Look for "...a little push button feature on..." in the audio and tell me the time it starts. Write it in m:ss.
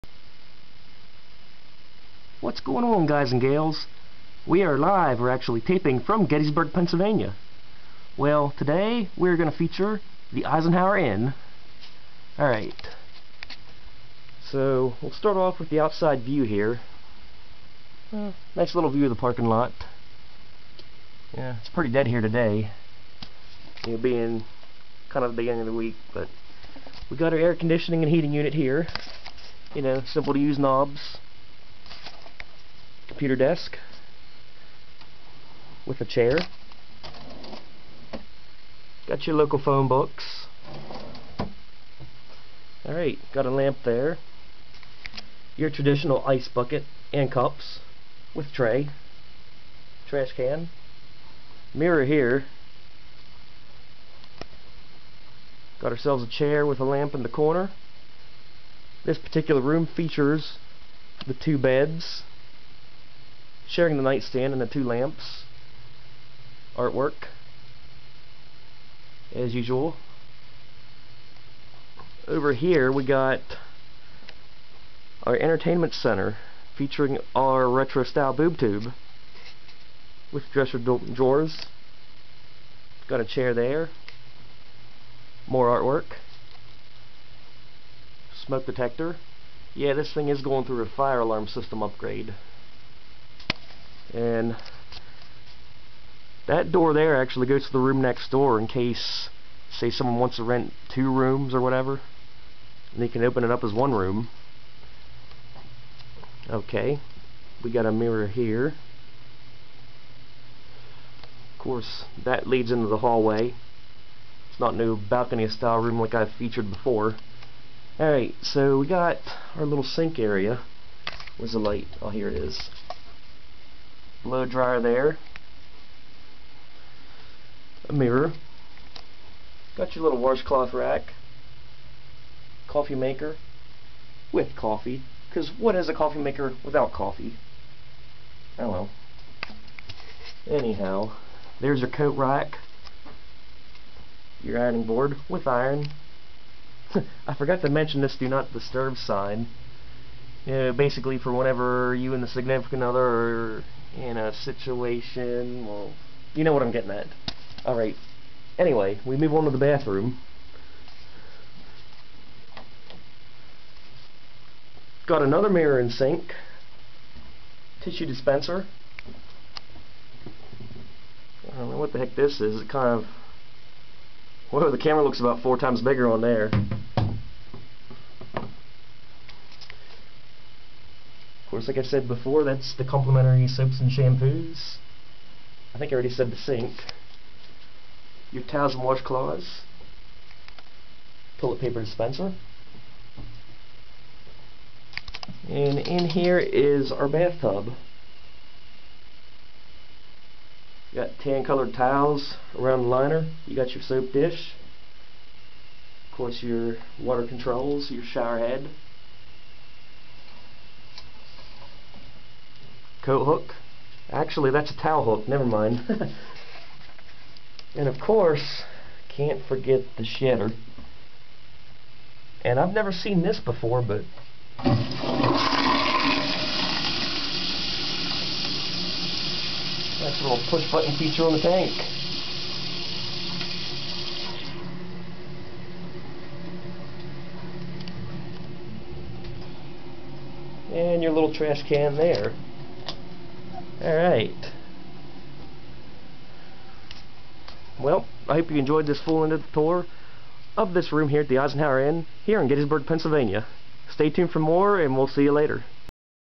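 3:50.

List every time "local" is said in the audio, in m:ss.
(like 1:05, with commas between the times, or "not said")
0:39.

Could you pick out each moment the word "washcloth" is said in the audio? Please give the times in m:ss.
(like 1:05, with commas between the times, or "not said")
2:10, 3:08.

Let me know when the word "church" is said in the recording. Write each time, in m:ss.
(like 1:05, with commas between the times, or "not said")
not said.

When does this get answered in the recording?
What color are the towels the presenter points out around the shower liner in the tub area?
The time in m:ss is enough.
3:21.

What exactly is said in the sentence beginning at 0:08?
Well, today we're going to feature the Eisenhower Inn.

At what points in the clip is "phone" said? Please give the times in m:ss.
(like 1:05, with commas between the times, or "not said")
0:39.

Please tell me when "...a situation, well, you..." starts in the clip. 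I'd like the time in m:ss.
2:34.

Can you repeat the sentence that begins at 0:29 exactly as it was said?
You know, simple to use knobs computer desk with a chair.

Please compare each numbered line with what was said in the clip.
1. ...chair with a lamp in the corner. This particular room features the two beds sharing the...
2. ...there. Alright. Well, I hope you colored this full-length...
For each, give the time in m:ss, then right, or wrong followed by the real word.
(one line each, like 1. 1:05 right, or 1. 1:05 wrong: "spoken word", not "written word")
1. 0:56 right
2. 4:01 wrong: "enjoyed", not "colored".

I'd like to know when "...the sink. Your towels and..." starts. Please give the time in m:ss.
3:06.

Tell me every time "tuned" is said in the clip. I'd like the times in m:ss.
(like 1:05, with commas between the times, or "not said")
4:14.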